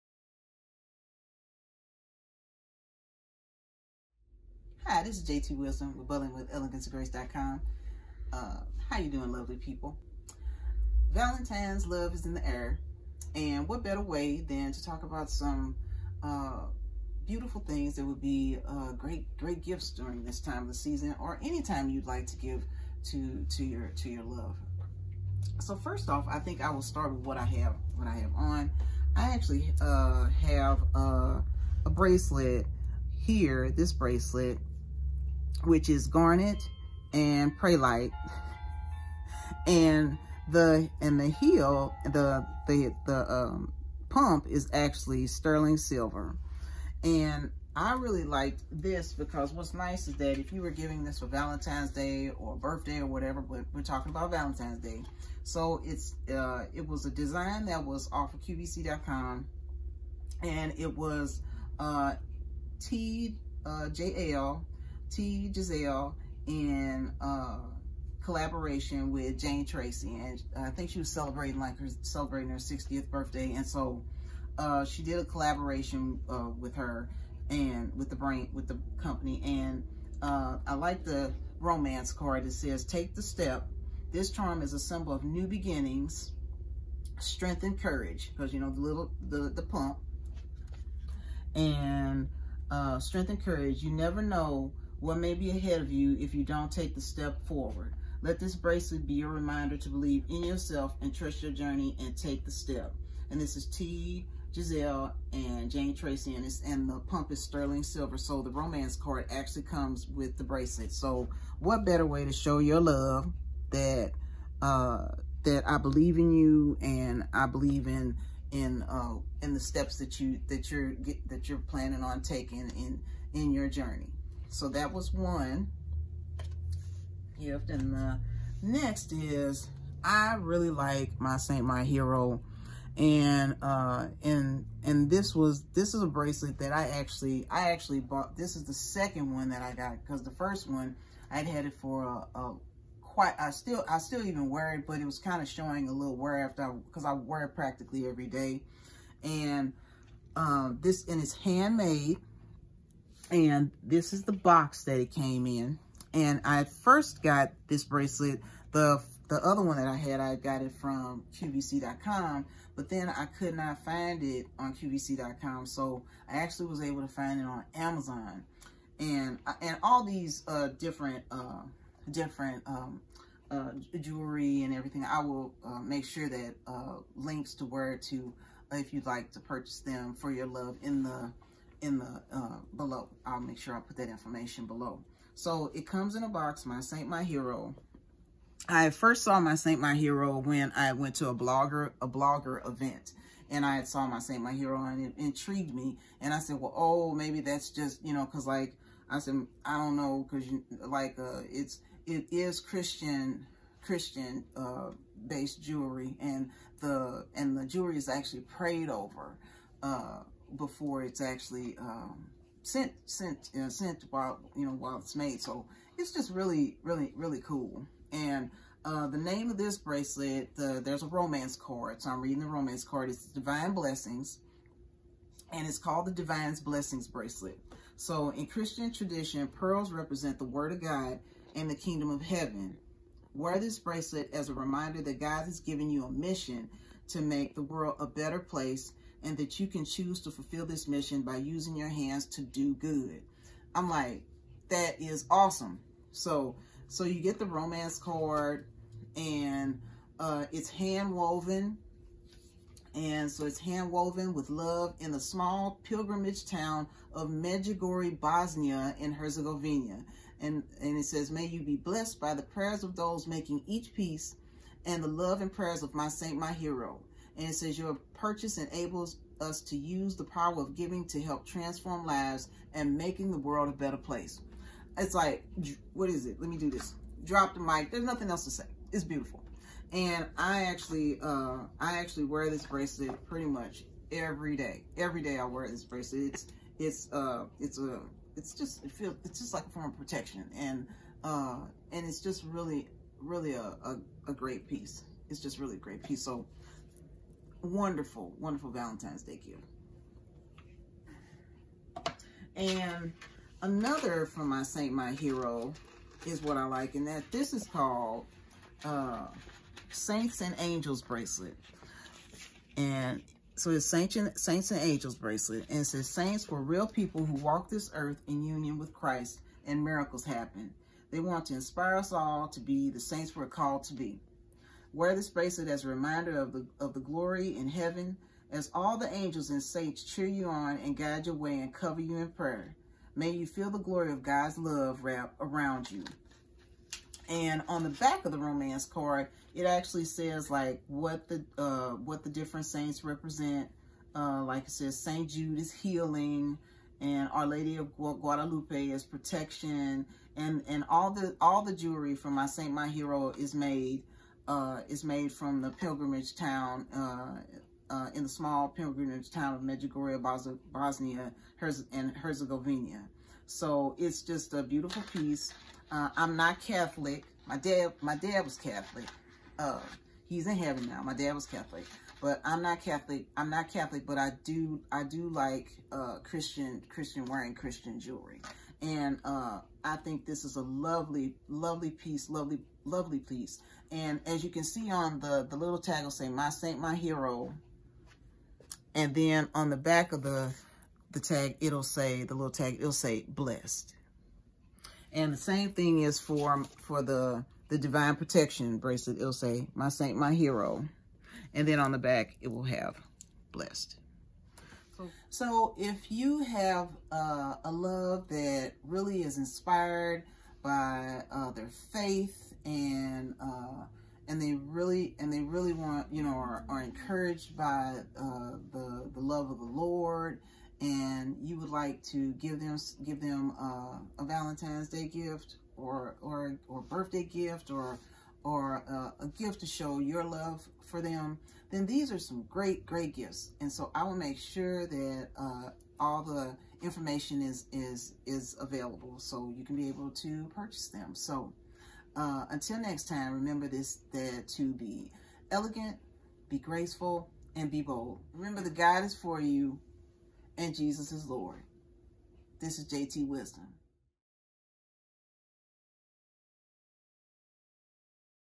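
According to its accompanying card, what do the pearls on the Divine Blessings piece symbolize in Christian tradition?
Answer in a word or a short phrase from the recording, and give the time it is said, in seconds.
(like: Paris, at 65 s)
The Word of God and the Kingdom of Heaven, at 230 s.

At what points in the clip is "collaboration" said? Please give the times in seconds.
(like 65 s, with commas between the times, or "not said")
68 s, 75 s.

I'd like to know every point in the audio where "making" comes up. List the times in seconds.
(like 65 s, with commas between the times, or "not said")
263 s, 272 s.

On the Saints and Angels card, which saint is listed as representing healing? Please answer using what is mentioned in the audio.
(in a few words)
Saint Jude.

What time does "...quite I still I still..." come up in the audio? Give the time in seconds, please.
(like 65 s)
143 s.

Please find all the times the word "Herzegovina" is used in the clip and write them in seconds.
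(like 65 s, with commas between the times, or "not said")
259 s, 362 s.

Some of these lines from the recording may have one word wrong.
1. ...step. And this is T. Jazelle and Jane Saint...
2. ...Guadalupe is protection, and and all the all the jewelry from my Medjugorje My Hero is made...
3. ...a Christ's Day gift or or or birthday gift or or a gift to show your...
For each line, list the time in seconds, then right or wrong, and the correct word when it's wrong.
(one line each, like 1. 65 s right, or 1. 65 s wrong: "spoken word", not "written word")
1. 102 s wrong: "Treacy", not "Saint"
2. 348 s wrong: "Saint", not "Medjugorje"
3. 424 s wrong: "Valentine", not "Christ".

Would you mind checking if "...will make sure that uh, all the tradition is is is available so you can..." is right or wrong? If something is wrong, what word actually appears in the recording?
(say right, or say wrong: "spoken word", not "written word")
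wrong: "information", not "tradition".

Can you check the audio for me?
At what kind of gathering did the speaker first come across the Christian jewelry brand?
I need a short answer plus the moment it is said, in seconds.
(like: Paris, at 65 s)
A blogger event, at 192 s.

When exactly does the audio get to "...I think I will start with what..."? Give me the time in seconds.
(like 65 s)
26 s.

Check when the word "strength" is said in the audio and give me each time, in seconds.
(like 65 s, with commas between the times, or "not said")
87 s, 92 s.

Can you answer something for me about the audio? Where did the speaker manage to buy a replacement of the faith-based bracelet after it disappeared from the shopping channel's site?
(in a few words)
Amazon.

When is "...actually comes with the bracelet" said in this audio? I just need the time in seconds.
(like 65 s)
109 s.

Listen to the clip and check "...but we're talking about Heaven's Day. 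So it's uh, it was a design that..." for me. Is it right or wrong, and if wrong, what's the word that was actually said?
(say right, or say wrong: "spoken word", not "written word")
wrong: "Valentine", not "Heaven".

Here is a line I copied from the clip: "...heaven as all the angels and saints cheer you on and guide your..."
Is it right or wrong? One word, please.
right.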